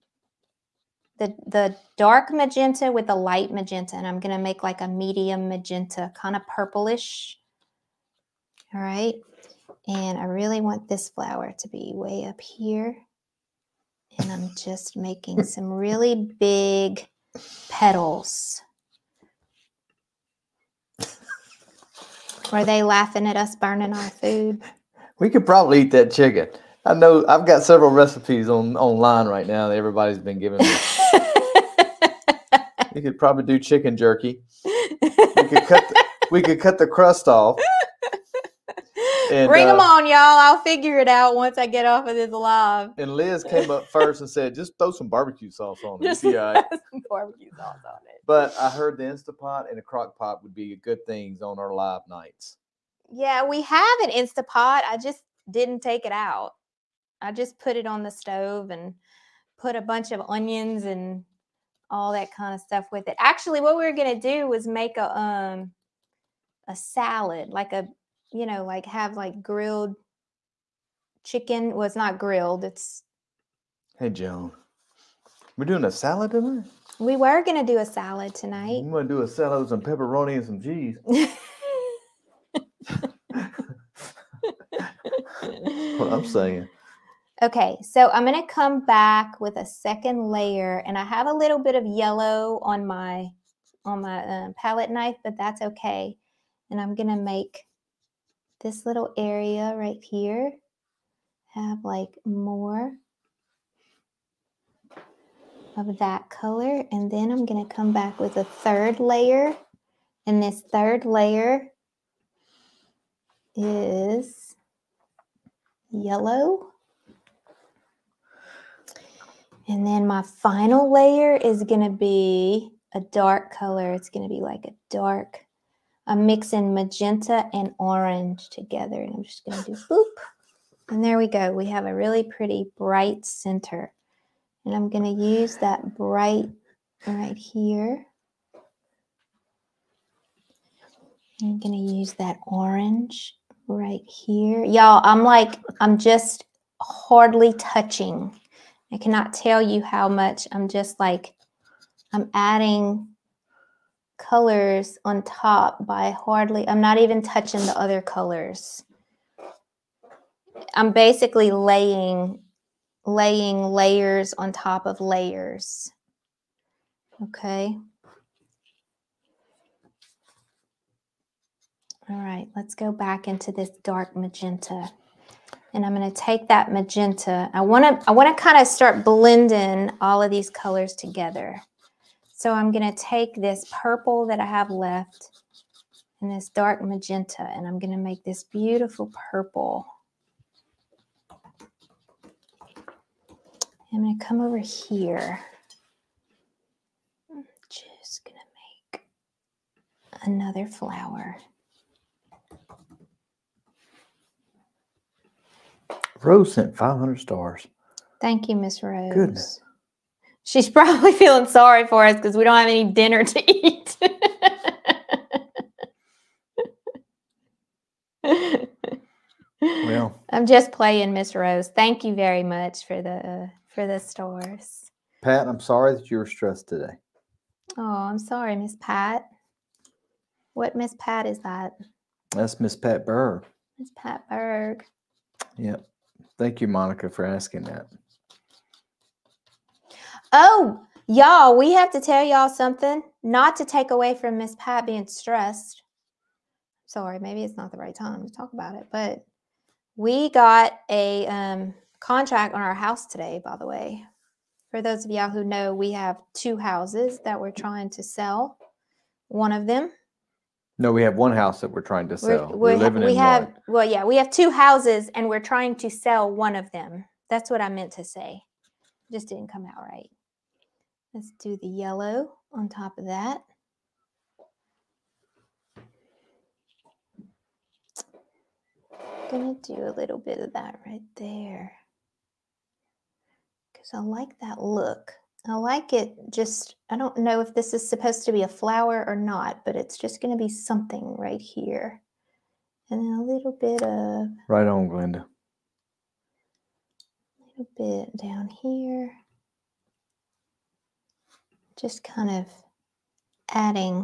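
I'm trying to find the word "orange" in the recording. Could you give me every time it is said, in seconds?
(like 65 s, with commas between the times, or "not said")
127 s, 142 s.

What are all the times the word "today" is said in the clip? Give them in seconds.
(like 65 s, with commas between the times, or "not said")
226 s, 253 s.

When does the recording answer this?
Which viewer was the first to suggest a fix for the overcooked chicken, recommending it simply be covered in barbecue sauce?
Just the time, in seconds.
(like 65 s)
43 s.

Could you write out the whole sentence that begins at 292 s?
And then a little bit of...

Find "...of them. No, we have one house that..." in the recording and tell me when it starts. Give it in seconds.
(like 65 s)
259 s.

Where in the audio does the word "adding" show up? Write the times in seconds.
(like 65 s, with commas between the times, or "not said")
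152 s, 303 s.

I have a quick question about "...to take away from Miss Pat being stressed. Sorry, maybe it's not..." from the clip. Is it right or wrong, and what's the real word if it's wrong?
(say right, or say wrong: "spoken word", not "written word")
right.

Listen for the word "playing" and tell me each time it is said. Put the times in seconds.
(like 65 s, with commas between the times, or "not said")
220 s.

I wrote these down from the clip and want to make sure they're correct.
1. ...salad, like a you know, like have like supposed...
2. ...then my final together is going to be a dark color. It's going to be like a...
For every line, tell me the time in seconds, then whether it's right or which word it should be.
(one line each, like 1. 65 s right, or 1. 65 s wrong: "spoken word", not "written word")
1. 66 s wrong: "grilled", not "supposed"
2. 119 s wrong: "layer", not "together".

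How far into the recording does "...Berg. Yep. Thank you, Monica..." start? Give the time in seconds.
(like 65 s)
234 s.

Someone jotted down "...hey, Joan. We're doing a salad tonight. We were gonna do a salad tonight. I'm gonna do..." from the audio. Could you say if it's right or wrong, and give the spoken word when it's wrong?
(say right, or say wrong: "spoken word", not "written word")
right.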